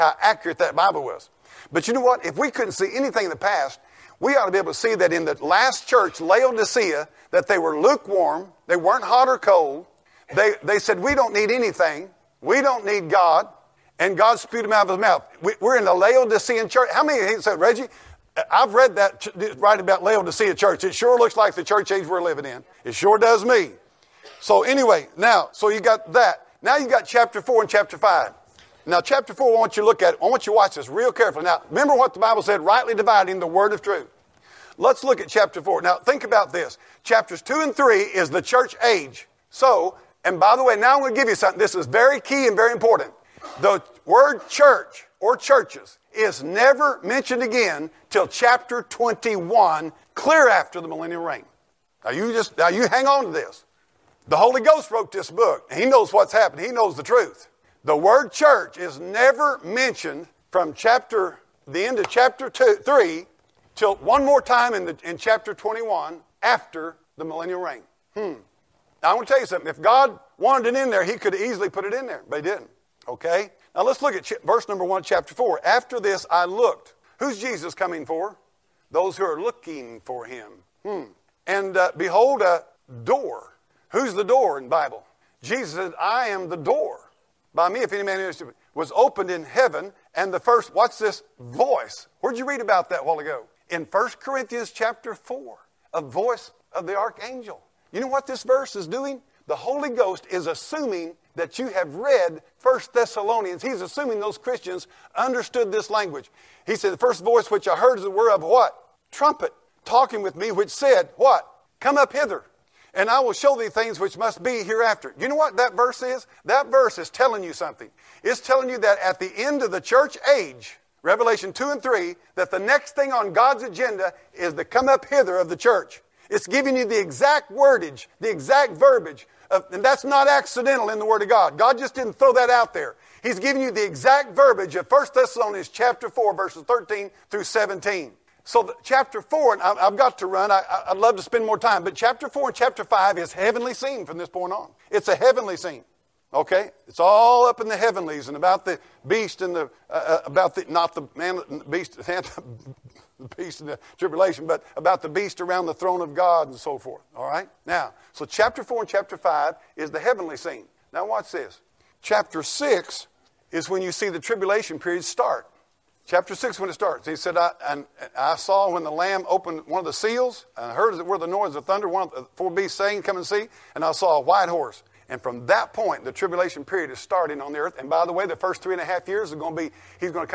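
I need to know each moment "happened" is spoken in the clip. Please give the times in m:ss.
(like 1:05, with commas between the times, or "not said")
0:56.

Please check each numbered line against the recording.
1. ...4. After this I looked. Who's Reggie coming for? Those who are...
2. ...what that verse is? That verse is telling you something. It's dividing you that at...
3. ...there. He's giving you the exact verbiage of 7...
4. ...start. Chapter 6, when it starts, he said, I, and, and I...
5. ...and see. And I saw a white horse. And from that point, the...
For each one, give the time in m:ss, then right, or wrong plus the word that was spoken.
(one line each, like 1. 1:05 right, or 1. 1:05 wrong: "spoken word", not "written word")
1. 1:15 wrong: "Jesus", not "Reggie"
2. 1:55 wrong: "telling", not "dividing"
3. 2:12 wrong: "1", not "7"
4. 2:45 right
5. 2:53 right.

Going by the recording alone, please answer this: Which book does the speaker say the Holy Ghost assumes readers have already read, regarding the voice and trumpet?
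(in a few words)
First Thessalonians.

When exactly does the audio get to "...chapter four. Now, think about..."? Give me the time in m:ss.
0:35.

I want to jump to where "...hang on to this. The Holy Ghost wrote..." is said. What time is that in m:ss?
0:52.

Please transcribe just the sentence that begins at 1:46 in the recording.
He said, The first voice which I heard is the word of what?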